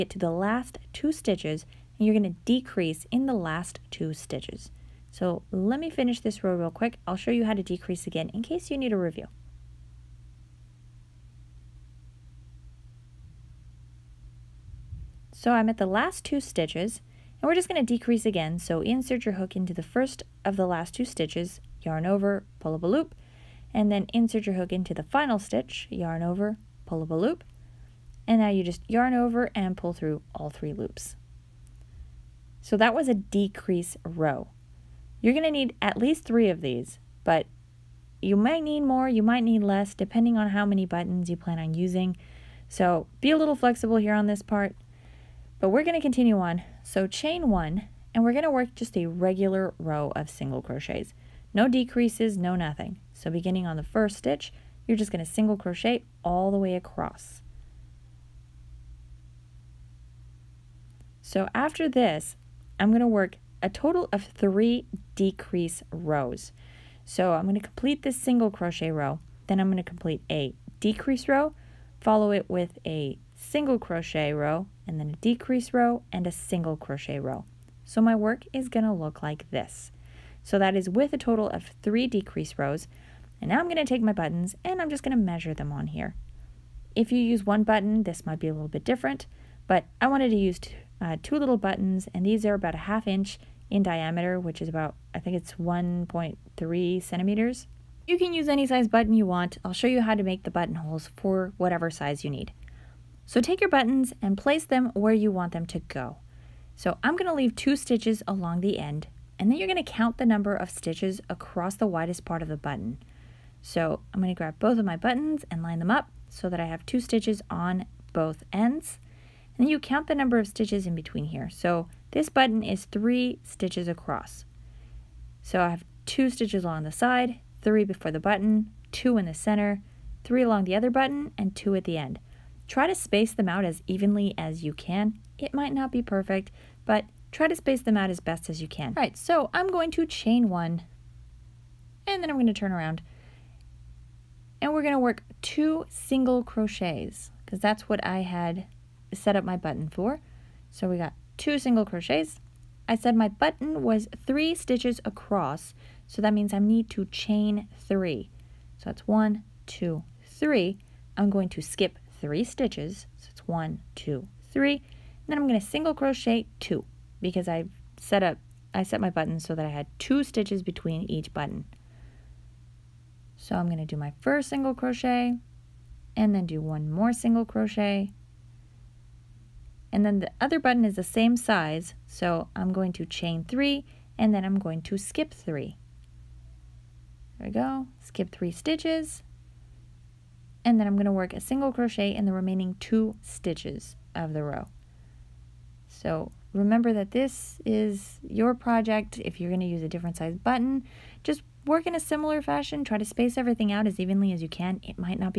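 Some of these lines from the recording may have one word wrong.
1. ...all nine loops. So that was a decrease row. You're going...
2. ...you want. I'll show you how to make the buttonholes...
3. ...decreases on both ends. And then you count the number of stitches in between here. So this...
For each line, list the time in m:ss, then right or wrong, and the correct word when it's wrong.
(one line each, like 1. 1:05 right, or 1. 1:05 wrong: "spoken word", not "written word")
1. 0:30 wrong: "three", not "nine"
2. 1:39 right
3. 1:56 wrong: "stitches", not "decreases".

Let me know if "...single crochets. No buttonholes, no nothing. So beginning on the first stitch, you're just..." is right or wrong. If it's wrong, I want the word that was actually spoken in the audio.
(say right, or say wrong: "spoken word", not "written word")
wrong: "decreases", not "buttonholes".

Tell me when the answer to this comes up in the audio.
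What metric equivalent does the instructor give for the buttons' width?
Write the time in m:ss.
1:35.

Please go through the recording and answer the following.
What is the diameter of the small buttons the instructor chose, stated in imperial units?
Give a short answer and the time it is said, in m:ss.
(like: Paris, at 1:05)
Half inch, at 1:32.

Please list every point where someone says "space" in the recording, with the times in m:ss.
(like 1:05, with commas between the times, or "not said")
2:12, 2:17, 3:23.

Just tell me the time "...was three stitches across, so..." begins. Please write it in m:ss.
2:33.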